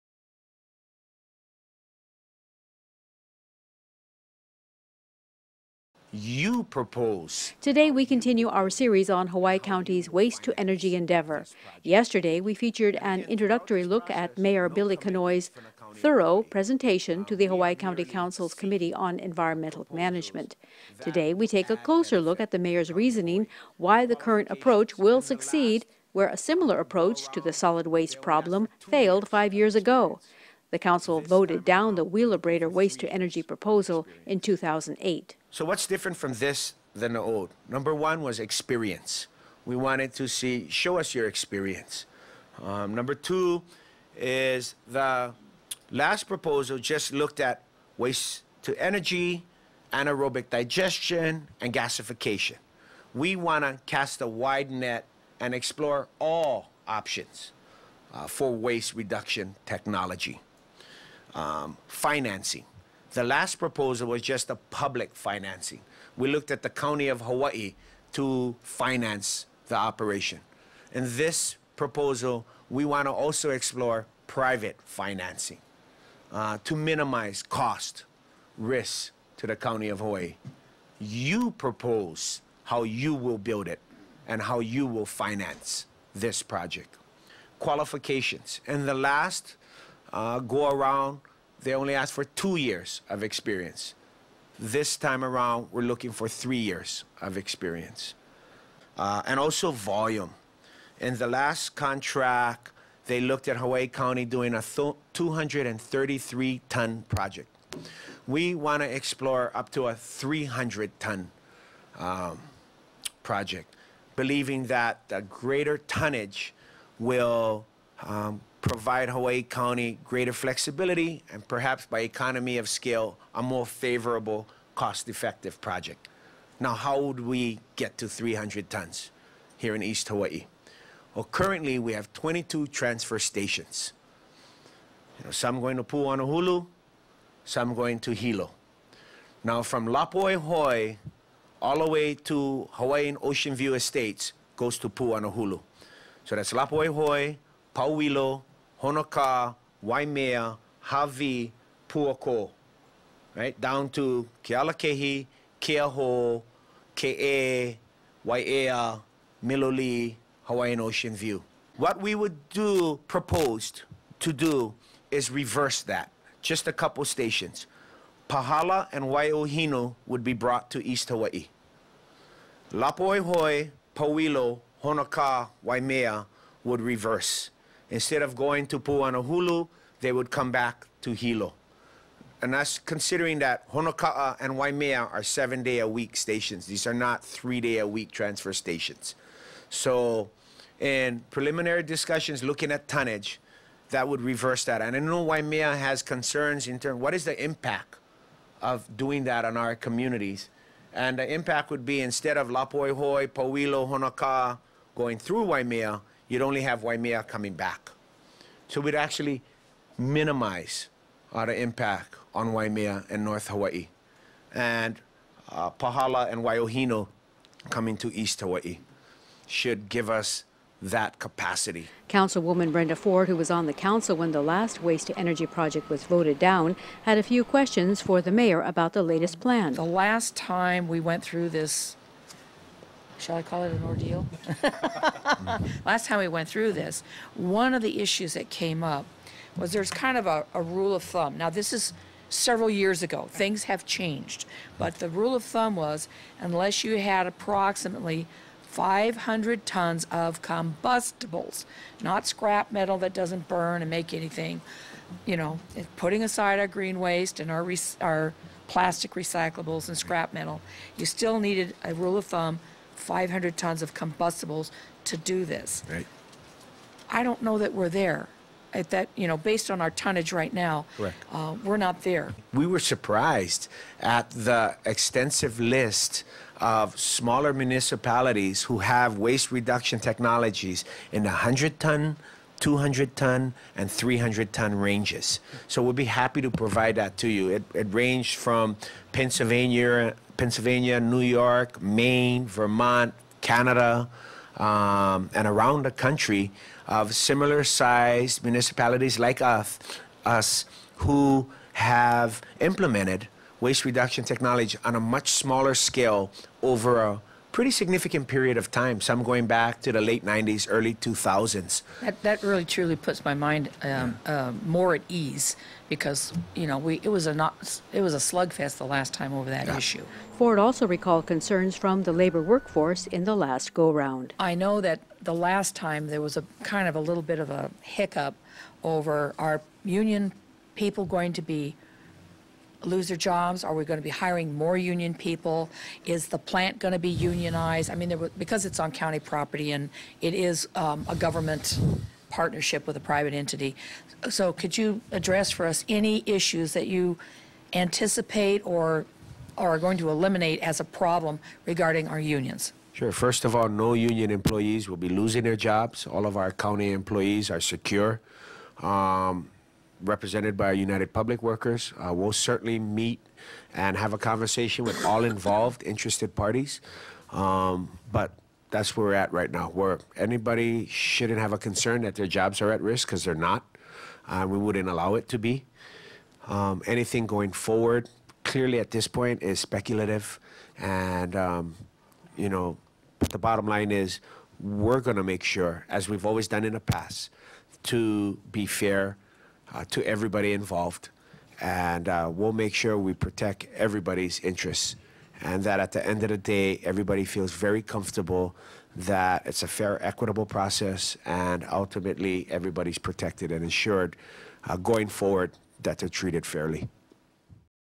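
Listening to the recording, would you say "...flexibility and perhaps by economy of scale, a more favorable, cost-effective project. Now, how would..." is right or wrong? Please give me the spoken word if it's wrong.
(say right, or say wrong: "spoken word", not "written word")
right.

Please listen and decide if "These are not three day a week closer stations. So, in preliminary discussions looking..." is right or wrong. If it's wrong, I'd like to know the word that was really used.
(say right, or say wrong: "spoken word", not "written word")
wrong: "transfer", not "closer".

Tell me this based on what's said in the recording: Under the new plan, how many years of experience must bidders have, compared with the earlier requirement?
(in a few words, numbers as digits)
3 years.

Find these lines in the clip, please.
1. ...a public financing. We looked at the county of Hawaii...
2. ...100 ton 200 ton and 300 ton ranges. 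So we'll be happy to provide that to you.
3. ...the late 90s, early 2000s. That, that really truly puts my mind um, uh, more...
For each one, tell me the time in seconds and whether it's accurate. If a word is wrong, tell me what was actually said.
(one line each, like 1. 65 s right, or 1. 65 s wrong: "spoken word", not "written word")
1. 64 s right
2. 281 s right
3. 309 s right.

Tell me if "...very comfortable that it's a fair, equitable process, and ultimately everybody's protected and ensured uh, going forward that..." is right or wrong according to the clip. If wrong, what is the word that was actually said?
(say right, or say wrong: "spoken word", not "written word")
right.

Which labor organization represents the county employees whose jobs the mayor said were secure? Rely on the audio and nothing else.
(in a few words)
United Public Workers.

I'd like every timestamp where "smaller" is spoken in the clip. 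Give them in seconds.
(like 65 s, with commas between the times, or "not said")
276 s, 305 s.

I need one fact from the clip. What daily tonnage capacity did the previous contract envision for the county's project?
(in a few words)
233 tons.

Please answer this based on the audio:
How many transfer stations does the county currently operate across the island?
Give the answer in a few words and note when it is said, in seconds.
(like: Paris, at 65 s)
22, at 132 s.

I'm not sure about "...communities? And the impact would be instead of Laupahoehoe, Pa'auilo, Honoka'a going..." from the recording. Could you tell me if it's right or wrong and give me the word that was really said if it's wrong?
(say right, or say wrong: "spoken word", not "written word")
right.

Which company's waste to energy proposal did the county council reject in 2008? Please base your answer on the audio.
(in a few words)
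Wheelabrator.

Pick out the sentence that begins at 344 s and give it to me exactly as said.
So could you address for us any issues that you anticipate or are going to eliminate as a problem regarding our unions?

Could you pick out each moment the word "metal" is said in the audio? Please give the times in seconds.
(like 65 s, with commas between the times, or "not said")
252 s, 260 s.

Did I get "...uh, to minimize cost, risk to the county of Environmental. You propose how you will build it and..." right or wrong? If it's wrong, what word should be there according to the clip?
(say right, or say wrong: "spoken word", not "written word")
wrong: "Hawaii", not "Environmental".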